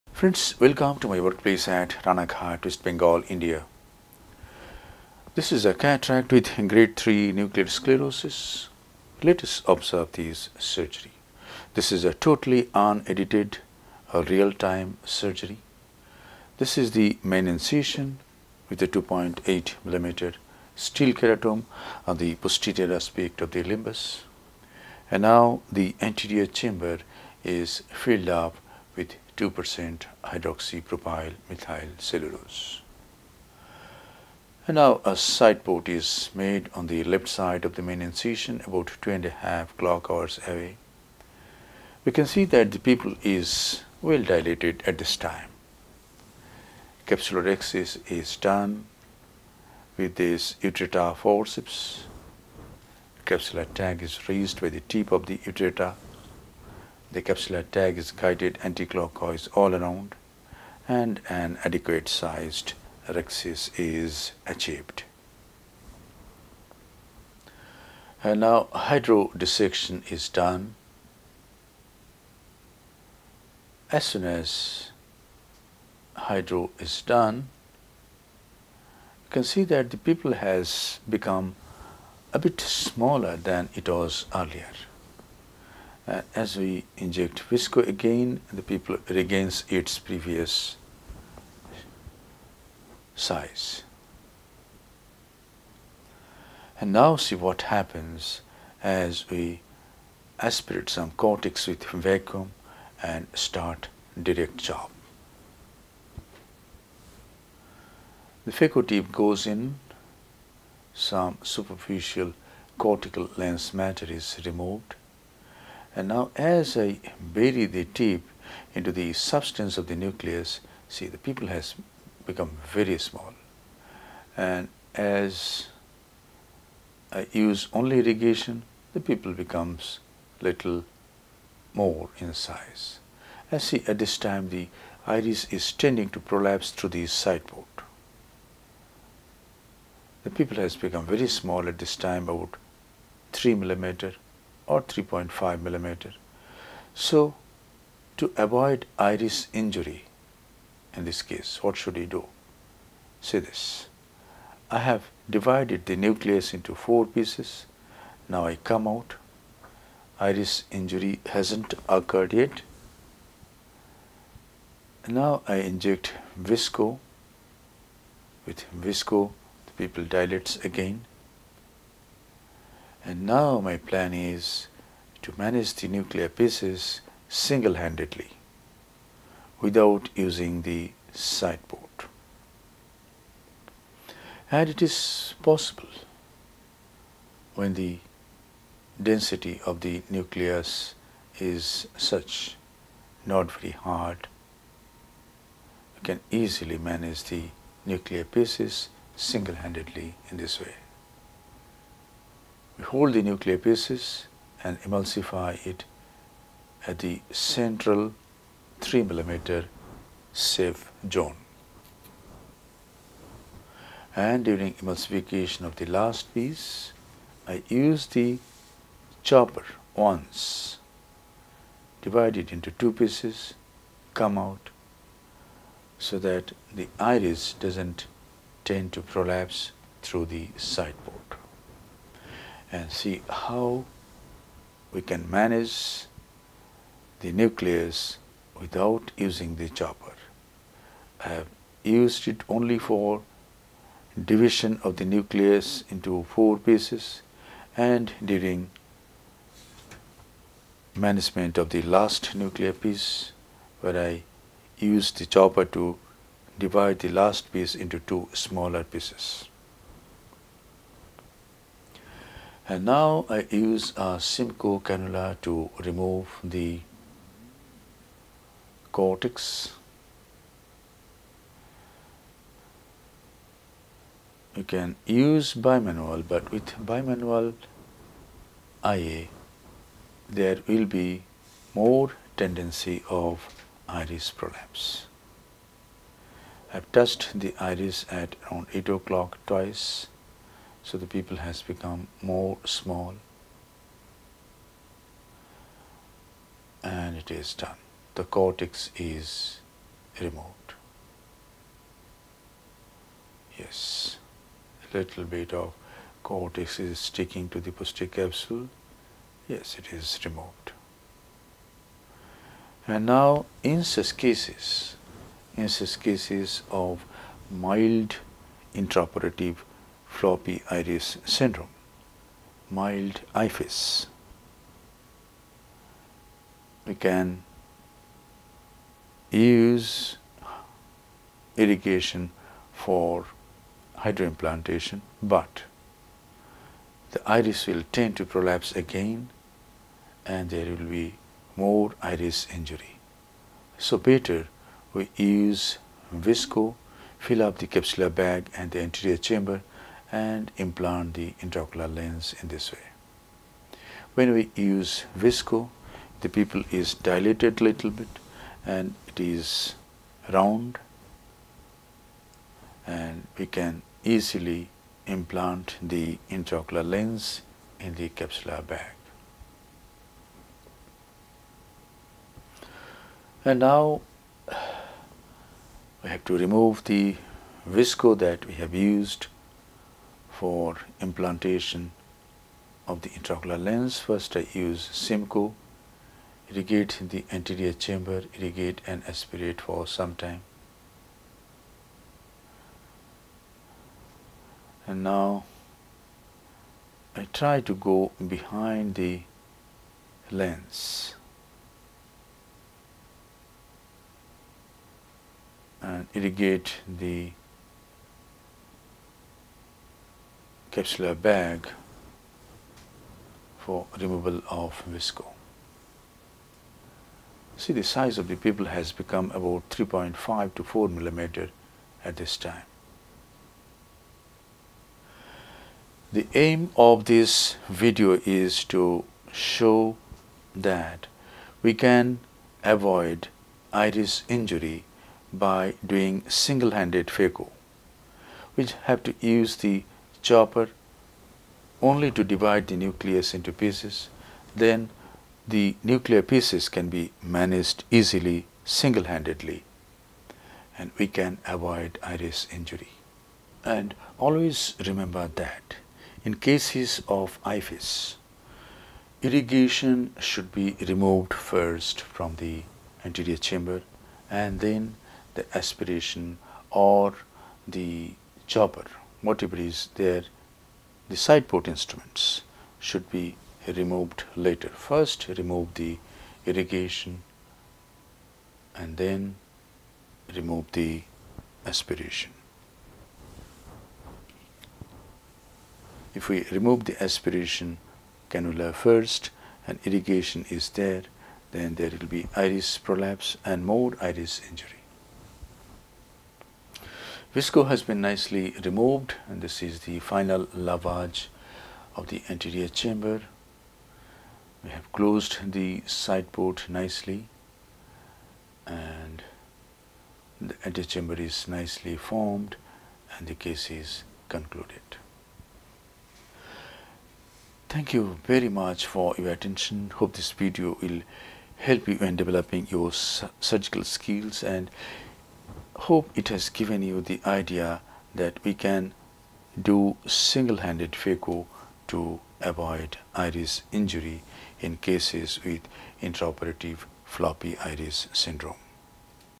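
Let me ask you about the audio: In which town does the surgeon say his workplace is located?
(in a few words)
Ranaghat.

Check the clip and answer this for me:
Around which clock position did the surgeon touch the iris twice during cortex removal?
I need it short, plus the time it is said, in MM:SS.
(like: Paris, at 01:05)
8 o'clock, at 04:48.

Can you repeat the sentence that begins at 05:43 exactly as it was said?
So better we use visco, fill up the capsular bag and the anterior chamber and implant the intraocular lens in this way.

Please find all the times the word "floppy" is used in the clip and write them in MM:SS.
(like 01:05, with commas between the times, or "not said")
05:20, 08:57.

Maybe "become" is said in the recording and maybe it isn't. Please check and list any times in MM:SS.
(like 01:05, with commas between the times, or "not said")
01:21, 02:02, 02:09, 02:20, 04:51, 06:58.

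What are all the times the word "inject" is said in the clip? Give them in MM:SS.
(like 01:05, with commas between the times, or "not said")
01:26, 02:45.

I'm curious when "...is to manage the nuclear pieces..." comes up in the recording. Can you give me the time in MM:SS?
02:54.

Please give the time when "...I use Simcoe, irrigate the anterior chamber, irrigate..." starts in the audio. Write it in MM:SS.
06:24.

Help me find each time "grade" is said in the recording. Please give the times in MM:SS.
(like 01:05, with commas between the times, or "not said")
00:06.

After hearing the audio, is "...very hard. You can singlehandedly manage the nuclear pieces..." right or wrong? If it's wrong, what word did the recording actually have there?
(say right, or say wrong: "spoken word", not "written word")
wrong: "easily", not "singlehandedly".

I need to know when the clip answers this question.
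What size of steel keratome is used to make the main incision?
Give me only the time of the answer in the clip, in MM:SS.
00:18.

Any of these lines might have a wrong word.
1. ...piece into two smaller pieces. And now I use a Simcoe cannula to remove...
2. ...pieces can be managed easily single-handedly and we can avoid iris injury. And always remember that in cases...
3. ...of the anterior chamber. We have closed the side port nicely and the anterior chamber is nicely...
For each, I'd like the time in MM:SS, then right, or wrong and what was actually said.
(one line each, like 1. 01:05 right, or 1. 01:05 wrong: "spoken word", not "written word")
1. 04:17 right
2. 07:26 right
3. 08:21 right.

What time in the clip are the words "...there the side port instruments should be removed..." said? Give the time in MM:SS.
07:49.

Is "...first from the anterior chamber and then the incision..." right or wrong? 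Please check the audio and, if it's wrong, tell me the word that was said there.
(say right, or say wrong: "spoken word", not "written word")
wrong: "aspiration", not "incision".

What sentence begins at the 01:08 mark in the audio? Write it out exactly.
And uh, now hydrodissection is done.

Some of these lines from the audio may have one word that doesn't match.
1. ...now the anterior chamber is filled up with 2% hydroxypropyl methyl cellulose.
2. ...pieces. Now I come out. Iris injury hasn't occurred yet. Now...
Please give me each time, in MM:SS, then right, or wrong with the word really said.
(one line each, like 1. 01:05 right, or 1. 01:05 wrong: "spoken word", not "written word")
1. 00:25 right
2. 02:37 right.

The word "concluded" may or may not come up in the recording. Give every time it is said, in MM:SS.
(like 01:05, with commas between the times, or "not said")
08:34.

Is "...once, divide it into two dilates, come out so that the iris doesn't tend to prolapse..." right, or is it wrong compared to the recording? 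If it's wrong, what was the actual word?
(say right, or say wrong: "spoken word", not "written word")
wrong: "pieces", not "dilates".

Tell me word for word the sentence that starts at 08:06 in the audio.
If we remove the aspiration cannula first and irrigation is there then there will be iris prolapse and more iris injury.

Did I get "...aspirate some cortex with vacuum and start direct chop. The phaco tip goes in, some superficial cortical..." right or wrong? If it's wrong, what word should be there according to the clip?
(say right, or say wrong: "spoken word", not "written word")
right.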